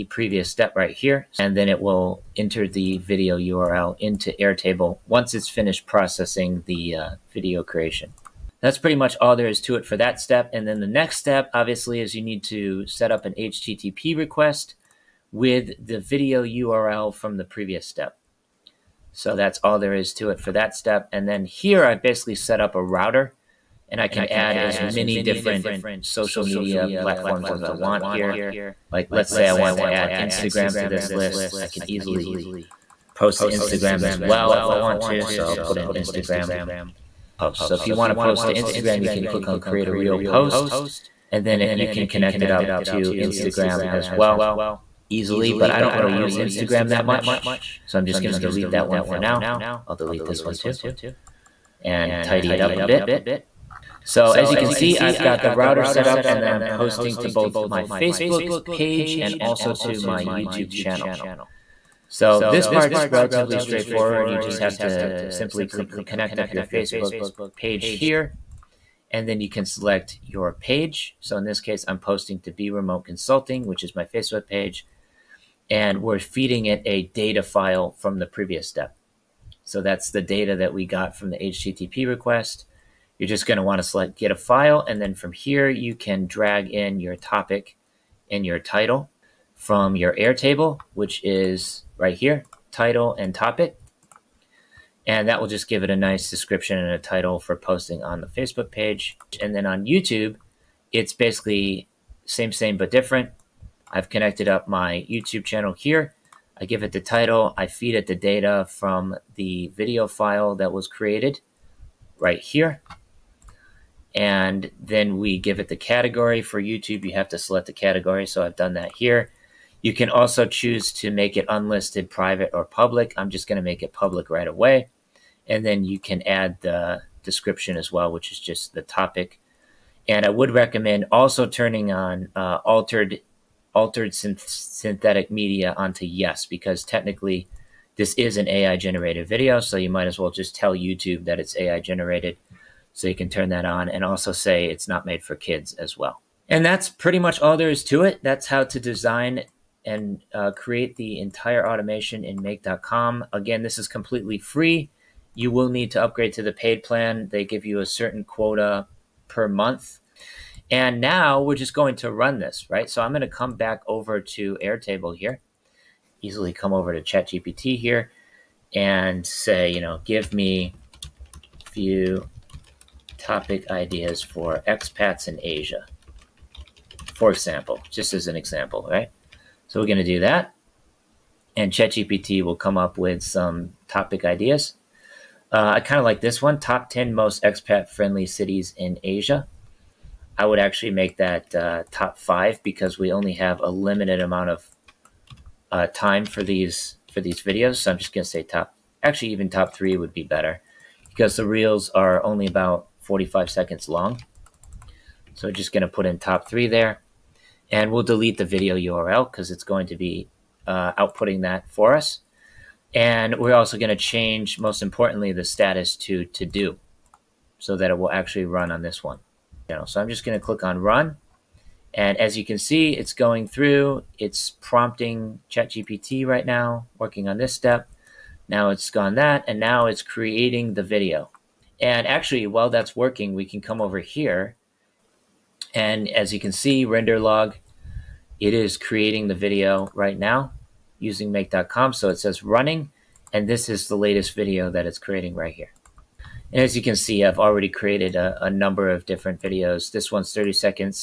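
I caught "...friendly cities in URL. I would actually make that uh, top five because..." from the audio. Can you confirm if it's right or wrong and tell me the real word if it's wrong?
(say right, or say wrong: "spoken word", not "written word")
wrong: "Asia", not "URL".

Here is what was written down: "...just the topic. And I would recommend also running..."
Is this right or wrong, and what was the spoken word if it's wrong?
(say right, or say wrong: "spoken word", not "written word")
wrong: "turning", not "running".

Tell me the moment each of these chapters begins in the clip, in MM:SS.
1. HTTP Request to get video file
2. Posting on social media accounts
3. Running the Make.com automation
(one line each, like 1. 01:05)
1. 00:11
2. 00:54
3. 03:41.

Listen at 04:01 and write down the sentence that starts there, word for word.
So it says running, and this is the latest video that it's creating right here.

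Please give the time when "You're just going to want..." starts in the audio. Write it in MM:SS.
01:23.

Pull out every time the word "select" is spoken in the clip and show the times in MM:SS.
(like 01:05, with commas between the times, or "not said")
01:09, 01:23, 01:57.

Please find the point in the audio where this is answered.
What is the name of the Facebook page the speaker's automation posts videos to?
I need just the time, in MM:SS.
01:12.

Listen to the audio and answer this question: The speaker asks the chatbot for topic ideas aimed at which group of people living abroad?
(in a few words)
Expats in Asia.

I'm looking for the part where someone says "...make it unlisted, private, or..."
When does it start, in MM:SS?
02:01.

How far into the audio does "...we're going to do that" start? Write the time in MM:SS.
02:59.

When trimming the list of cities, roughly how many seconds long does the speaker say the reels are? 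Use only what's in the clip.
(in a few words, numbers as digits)
45 seconds.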